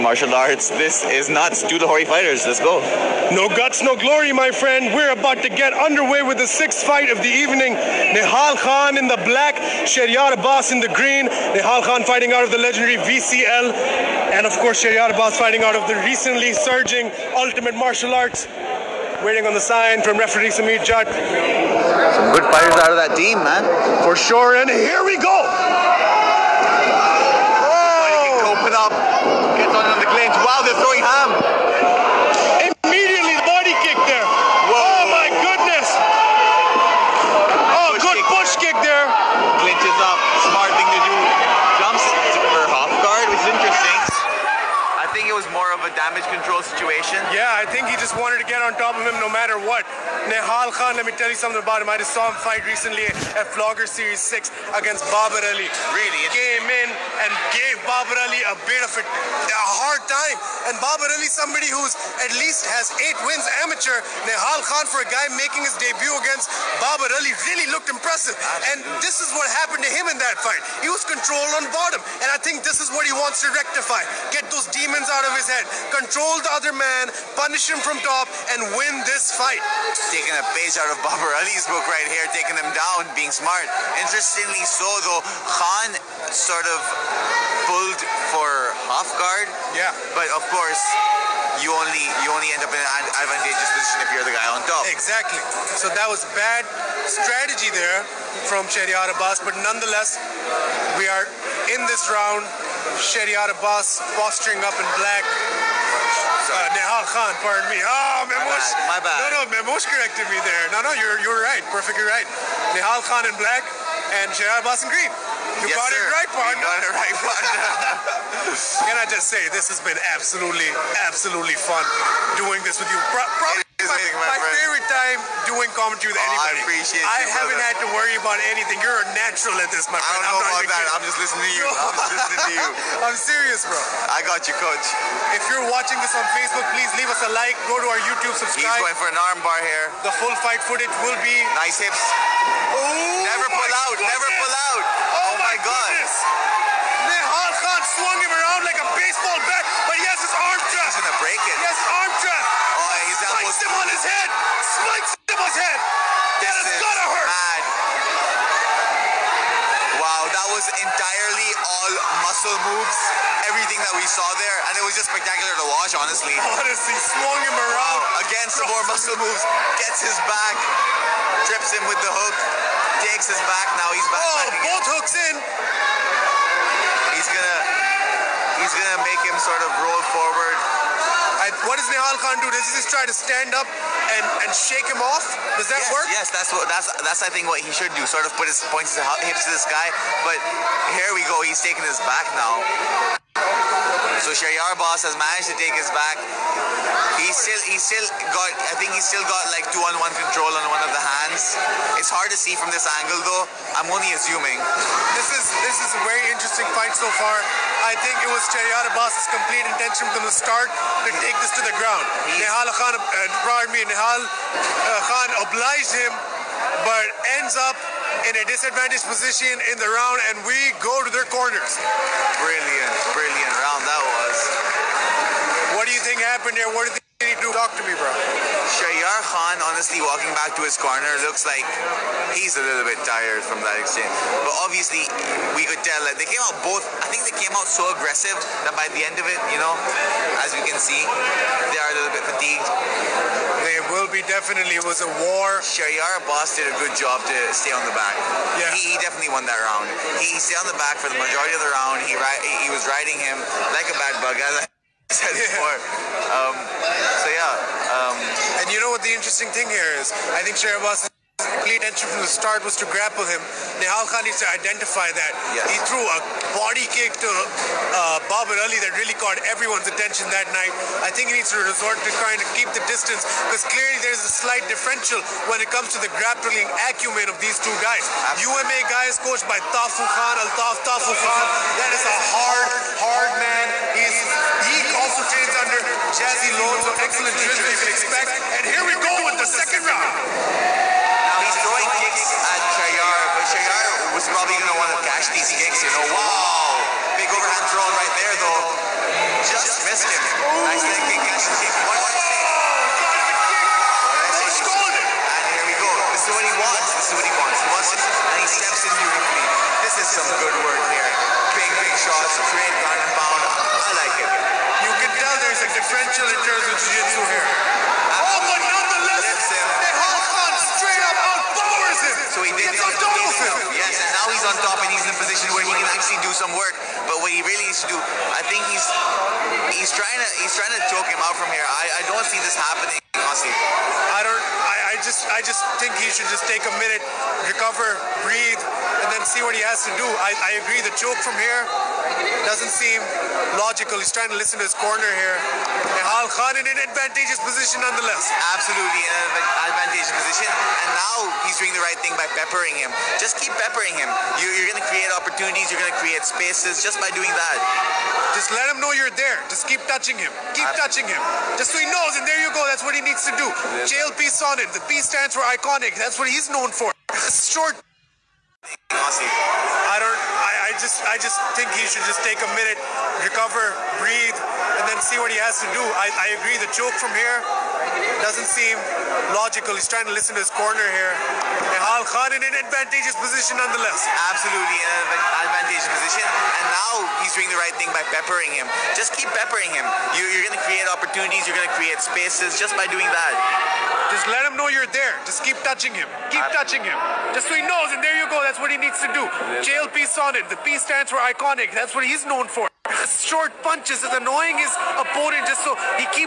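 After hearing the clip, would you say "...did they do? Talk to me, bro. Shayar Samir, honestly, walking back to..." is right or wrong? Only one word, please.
wrong.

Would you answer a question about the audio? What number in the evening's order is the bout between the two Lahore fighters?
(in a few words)
sixth.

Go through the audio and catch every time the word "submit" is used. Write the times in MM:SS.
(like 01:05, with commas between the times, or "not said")
not said.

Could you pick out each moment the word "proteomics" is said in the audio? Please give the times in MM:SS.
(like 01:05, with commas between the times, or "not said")
not said.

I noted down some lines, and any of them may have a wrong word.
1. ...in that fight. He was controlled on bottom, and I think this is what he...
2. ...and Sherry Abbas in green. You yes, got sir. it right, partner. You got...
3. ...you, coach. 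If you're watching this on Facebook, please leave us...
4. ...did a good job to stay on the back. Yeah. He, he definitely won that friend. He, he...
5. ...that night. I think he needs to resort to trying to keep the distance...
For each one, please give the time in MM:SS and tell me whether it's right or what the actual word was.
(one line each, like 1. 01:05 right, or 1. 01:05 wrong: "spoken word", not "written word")
1. 01:10 right
2. 01:54 right
3. 02:14 right
4. 04:06 wrong: "round", not "friend"
5. 04:30 right.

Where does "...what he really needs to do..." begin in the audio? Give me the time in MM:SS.
05:27.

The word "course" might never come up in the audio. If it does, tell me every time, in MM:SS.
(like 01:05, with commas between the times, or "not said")
00:14, 01:30.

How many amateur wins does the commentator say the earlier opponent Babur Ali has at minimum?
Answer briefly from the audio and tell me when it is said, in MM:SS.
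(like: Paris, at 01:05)
8, at 01:03.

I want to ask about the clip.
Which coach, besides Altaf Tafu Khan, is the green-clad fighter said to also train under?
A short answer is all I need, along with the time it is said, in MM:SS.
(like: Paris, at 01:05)
Jazzy Lone, at 04:46.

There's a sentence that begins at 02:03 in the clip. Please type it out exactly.
Pro probably my, my, my favorite time doing commentary with oh, anybody.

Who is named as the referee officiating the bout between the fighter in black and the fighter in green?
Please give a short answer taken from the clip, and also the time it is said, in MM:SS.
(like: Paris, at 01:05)
Samir Jat, at 00:20.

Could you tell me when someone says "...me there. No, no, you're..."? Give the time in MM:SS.
01:50.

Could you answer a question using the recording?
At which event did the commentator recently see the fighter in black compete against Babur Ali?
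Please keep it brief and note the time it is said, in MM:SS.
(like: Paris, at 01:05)
Flogger Series 6, at 00:53.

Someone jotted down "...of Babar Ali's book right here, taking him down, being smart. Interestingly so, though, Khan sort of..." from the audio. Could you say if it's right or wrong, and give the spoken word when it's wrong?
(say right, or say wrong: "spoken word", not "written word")
right.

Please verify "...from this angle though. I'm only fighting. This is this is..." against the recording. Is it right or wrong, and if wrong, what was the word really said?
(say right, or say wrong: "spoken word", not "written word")
wrong: "assuming", not "fighting".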